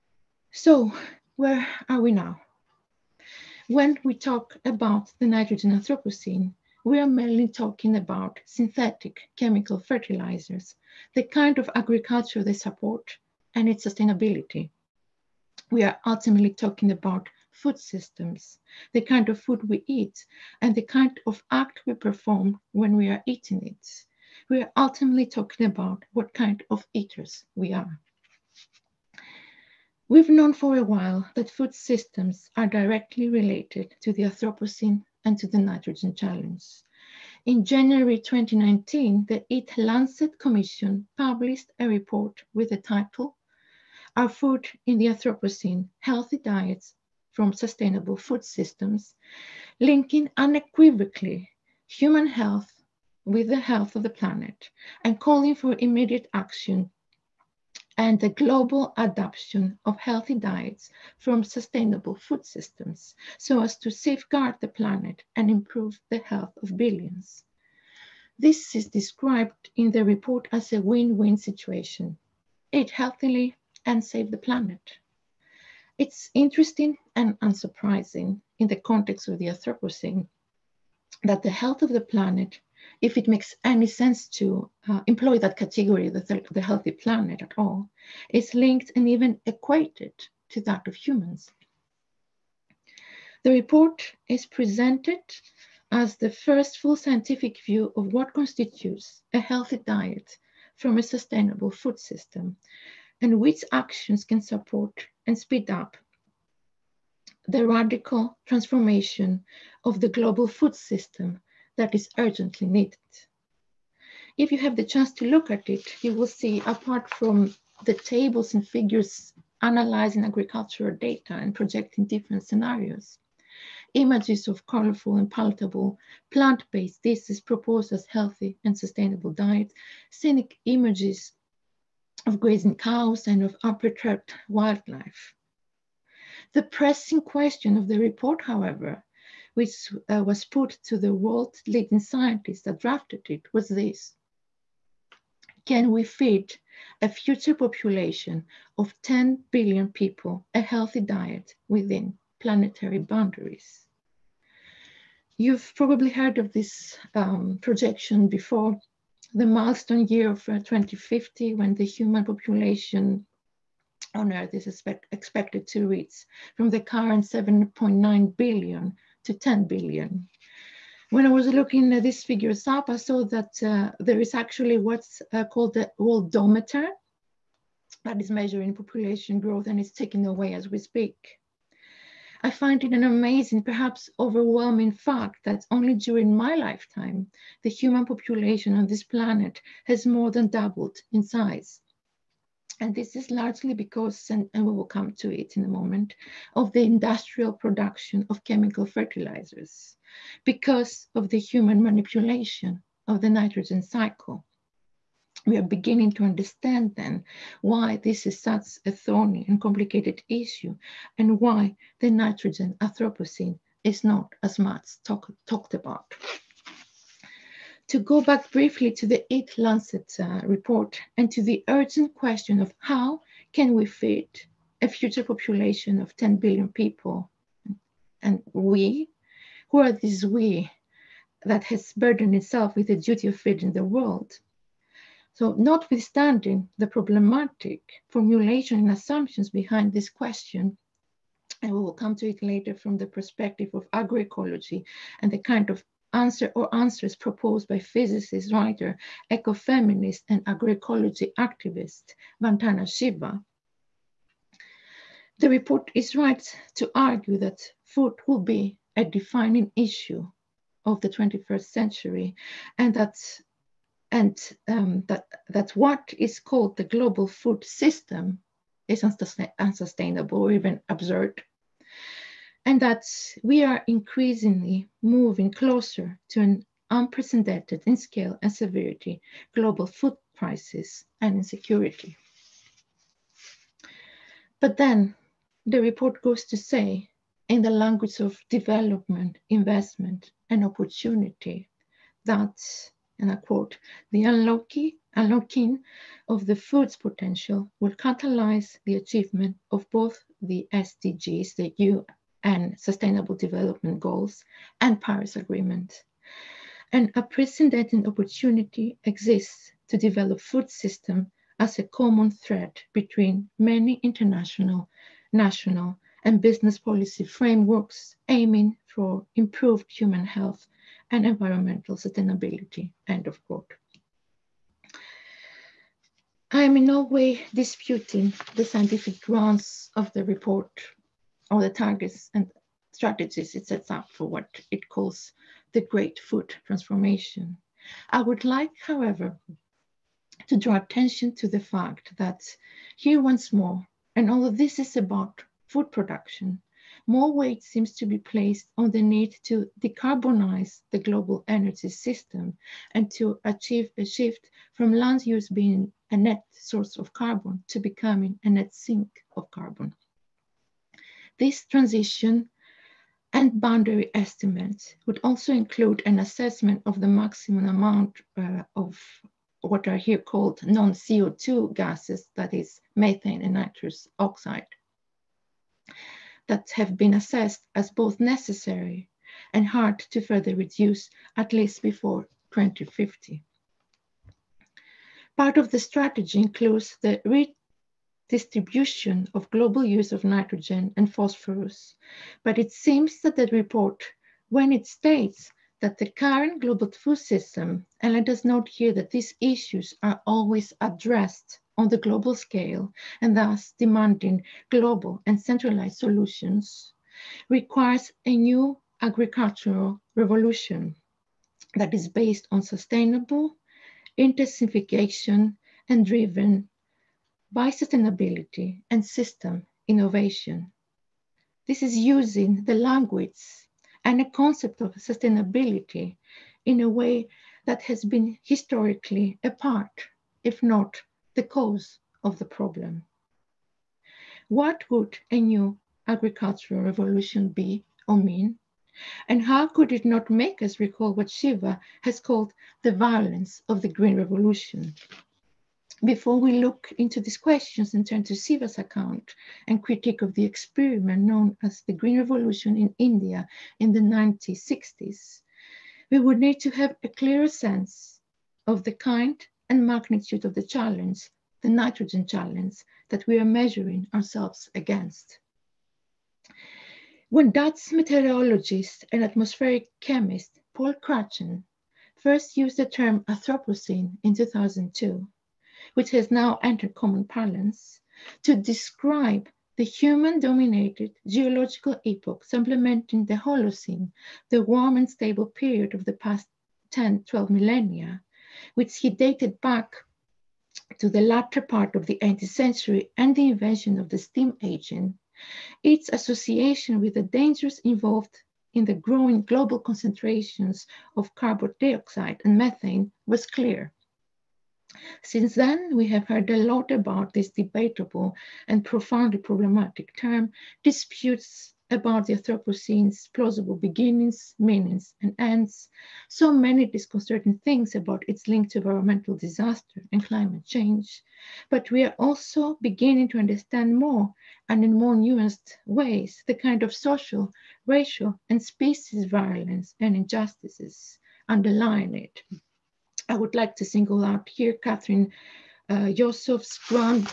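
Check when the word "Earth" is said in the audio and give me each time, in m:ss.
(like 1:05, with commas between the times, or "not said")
2:44.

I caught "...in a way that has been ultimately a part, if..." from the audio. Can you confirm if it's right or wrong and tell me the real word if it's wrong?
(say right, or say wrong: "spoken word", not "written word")
wrong: "historically", not "ultimately".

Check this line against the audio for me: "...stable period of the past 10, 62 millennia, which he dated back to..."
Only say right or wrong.
wrong.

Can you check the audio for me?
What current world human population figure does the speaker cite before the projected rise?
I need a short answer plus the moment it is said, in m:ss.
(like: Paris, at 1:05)
7.9 billion, at 2:47.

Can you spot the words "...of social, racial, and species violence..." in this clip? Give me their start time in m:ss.
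8:46.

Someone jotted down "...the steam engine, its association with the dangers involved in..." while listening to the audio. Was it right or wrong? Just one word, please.
right.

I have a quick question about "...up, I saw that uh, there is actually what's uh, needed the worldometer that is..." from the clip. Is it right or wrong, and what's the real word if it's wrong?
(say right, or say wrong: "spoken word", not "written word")
wrong: "called", not "needed".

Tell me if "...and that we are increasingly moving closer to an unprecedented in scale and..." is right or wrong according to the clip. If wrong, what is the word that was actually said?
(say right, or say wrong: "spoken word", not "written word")
right.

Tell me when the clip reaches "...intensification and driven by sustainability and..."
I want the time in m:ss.
6:54.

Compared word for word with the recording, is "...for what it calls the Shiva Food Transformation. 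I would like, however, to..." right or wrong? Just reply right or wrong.
wrong.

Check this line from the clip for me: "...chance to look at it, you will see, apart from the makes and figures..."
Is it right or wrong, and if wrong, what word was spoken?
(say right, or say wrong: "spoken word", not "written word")
wrong: "tables", not "makes".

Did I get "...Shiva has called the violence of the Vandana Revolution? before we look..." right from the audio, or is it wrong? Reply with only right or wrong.
wrong.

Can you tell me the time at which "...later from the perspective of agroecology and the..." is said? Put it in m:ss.
4:02.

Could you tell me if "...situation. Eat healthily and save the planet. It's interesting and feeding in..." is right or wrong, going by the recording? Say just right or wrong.
wrong.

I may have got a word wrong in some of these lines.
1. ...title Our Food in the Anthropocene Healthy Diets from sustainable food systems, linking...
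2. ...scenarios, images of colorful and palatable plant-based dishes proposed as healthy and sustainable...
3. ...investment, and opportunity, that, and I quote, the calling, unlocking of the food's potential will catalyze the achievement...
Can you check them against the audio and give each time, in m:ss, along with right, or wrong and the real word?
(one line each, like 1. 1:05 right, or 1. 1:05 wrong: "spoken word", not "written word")
1. 0:42 right
2. 2:02 right
3. 4:49 wrong: "unlocking", not "calling".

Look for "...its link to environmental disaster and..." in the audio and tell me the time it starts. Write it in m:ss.
8:38.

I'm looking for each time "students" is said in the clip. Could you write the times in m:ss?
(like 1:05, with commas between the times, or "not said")
not said.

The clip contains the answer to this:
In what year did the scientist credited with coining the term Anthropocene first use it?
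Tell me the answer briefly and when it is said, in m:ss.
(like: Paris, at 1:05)
2002, at 7:54.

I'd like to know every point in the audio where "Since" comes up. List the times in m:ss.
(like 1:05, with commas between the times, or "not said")
8:25.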